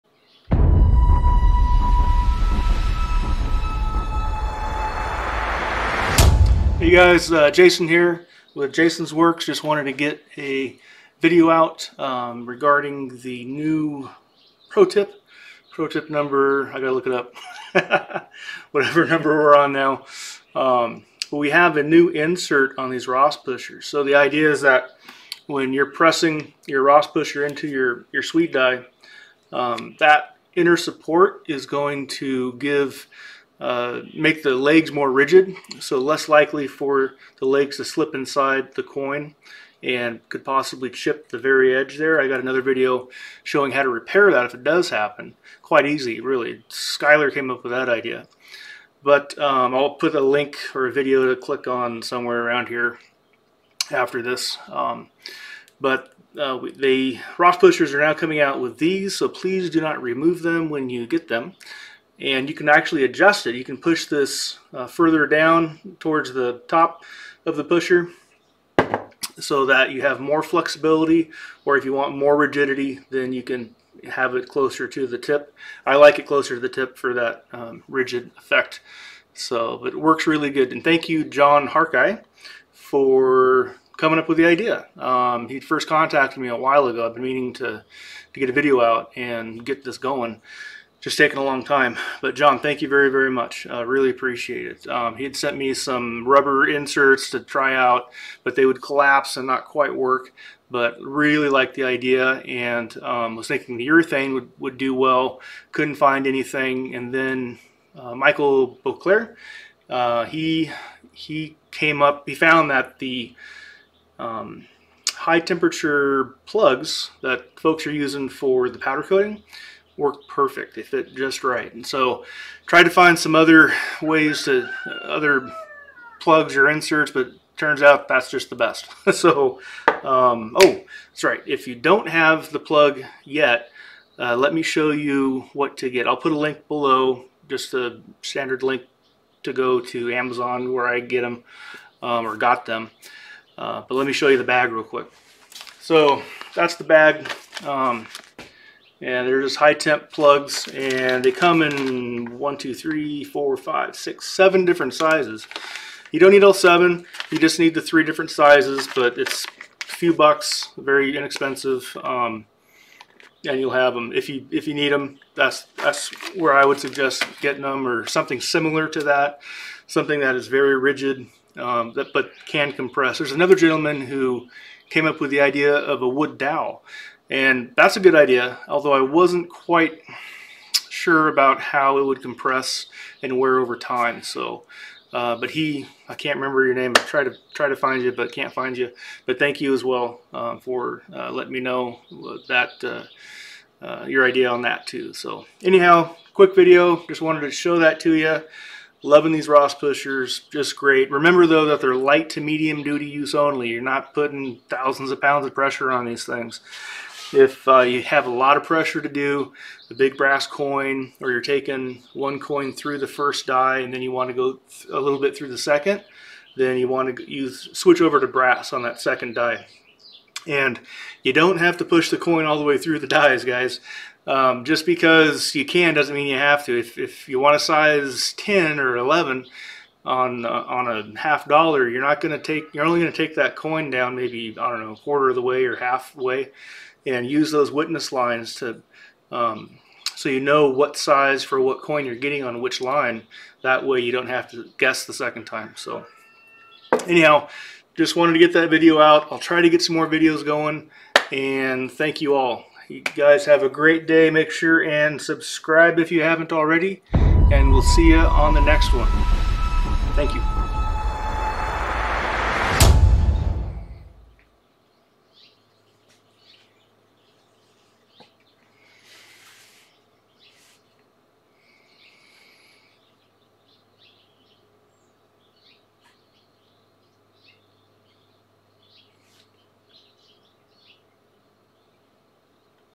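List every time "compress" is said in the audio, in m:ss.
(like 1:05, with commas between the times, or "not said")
2:52, 3:02.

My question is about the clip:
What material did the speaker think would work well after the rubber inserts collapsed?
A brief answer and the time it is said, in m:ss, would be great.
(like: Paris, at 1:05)
urethane, at 1:43.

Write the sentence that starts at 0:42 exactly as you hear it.
I got another video showing how to repair that if it does happen.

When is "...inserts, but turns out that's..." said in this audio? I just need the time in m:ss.
2:06.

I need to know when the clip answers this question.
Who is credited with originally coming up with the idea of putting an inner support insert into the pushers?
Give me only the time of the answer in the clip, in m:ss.
1:21.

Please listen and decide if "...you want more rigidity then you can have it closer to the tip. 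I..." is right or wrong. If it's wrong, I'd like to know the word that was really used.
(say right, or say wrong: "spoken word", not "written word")
right.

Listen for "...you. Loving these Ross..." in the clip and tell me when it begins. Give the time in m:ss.
3:18.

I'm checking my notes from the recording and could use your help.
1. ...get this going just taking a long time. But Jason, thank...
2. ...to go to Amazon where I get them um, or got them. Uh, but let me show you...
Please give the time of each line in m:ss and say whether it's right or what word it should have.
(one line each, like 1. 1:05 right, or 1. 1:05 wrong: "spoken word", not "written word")
1. 1:29 wrong: "John", not "Jason"
2. 2:19 right.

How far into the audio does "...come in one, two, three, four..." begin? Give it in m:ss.
2:31.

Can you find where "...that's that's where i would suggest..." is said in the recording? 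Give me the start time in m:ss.
2:45.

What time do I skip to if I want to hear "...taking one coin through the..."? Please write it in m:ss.
3:31.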